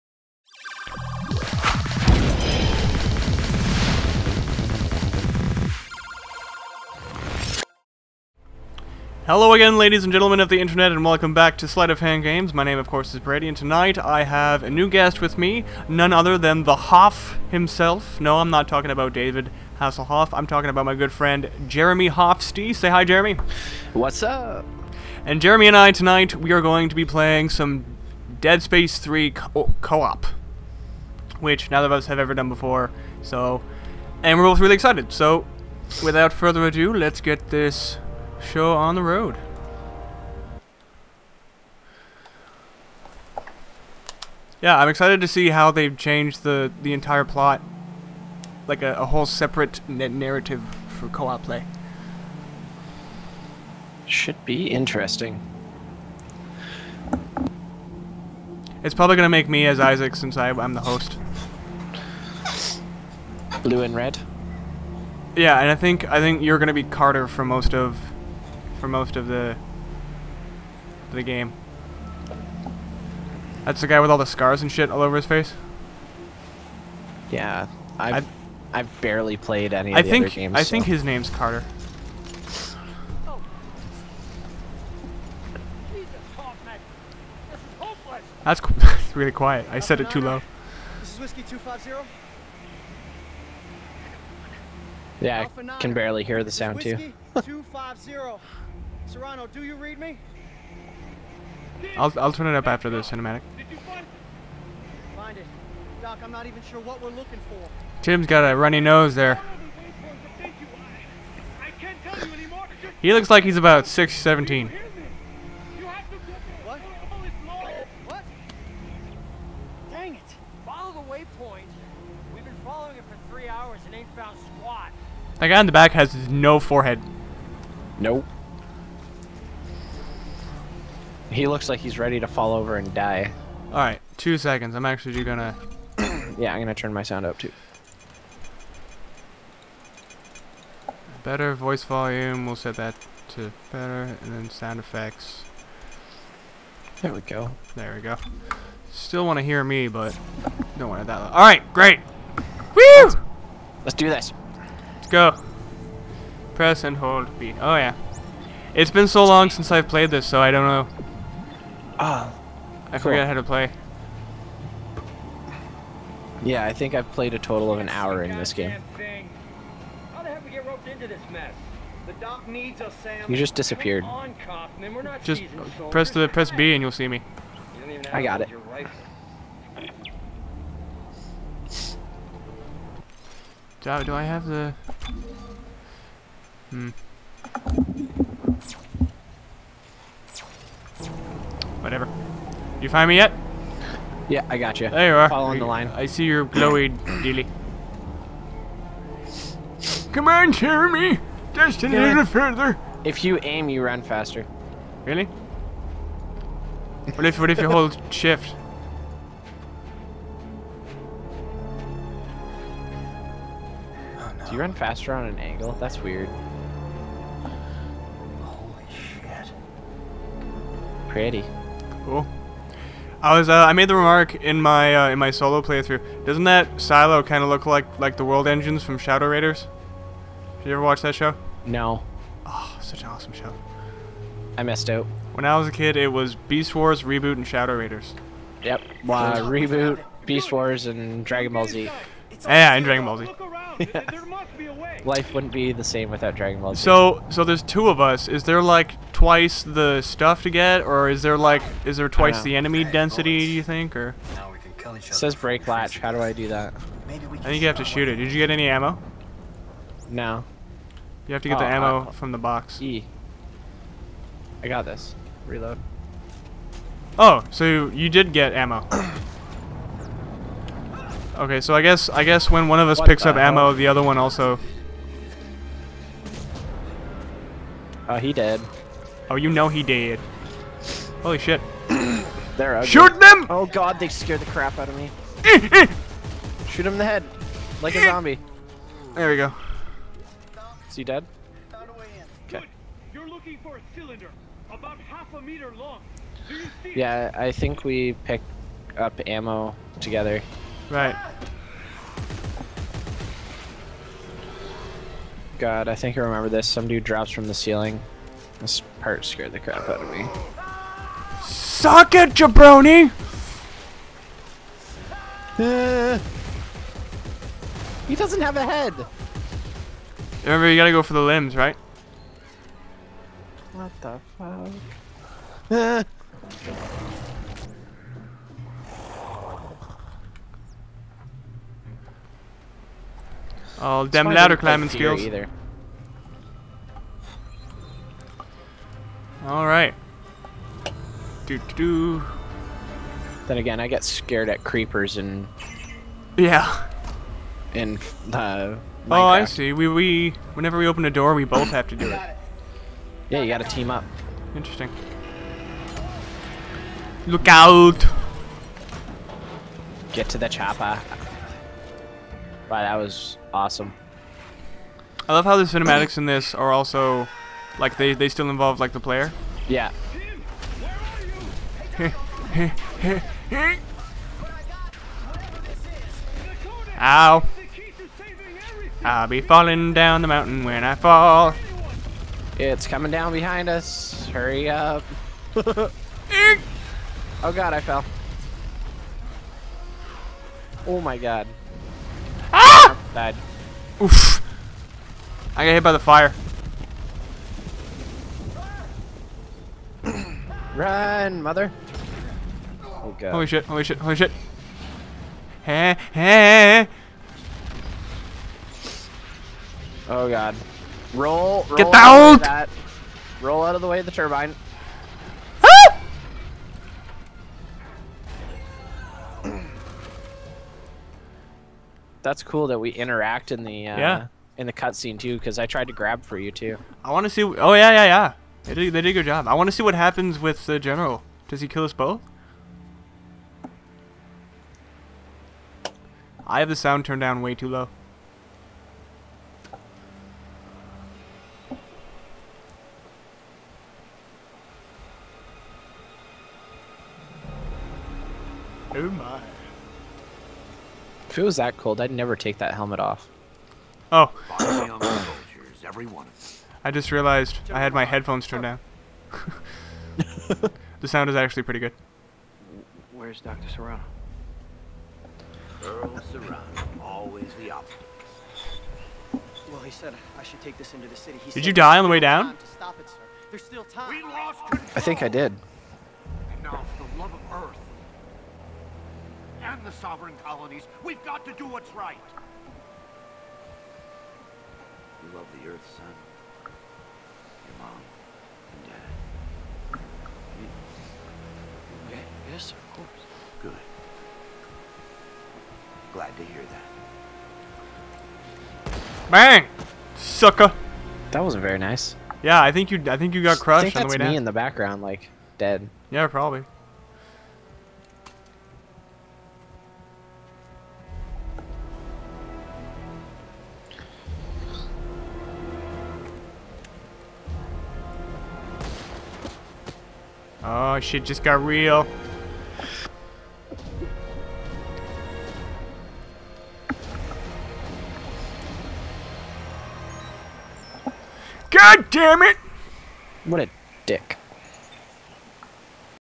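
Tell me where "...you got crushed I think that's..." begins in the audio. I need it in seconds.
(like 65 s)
503 s.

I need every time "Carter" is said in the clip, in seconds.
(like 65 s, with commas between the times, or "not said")
66 s, 81 s.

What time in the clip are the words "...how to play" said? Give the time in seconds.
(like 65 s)
163 s.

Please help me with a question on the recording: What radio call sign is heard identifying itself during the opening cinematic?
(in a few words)
Whiskey 250.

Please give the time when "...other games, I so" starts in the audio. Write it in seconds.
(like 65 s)
80 s.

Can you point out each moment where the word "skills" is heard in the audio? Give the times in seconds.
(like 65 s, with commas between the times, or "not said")
334 s.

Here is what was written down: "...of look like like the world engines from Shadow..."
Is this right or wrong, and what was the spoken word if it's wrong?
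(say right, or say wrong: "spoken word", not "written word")
right.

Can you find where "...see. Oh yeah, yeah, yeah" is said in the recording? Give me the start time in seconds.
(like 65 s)
427 s.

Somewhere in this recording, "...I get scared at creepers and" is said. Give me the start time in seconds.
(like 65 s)
343 s.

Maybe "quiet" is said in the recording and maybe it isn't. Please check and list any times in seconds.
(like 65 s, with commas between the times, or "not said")
89 s.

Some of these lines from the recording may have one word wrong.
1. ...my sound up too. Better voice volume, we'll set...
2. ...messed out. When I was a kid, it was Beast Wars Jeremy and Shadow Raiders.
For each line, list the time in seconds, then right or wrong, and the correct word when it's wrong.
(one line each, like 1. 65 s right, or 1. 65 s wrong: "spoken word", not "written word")
1. 136 s right
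2. 234 s wrong: "ReBoot", not "Jeremy".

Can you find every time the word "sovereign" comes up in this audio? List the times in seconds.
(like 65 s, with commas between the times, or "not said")
479 s.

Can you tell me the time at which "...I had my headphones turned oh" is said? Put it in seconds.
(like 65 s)
457 s.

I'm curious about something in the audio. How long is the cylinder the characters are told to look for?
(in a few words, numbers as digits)
Half a meter.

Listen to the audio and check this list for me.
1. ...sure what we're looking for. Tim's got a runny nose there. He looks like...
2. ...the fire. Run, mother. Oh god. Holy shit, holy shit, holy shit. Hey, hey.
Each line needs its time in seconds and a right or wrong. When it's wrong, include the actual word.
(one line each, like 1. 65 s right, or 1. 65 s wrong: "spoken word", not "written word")
1. 106 s right
2. 395 s right.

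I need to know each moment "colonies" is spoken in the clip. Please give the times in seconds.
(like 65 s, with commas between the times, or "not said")
480 s.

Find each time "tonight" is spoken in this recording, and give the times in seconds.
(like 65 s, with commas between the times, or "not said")
13 s, 25 s.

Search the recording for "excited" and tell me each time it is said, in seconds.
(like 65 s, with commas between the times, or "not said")
34 s, 44 s.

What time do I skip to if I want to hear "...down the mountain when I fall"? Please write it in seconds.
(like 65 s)
379 s.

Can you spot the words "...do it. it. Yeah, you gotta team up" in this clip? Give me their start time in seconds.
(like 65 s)
351 s.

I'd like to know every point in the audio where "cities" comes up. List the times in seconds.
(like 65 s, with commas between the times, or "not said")
not said.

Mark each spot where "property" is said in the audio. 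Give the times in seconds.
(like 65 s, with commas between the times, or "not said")
not said.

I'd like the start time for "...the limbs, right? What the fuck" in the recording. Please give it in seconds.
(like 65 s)
321 s.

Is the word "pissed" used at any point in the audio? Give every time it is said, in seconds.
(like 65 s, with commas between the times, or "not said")
not said.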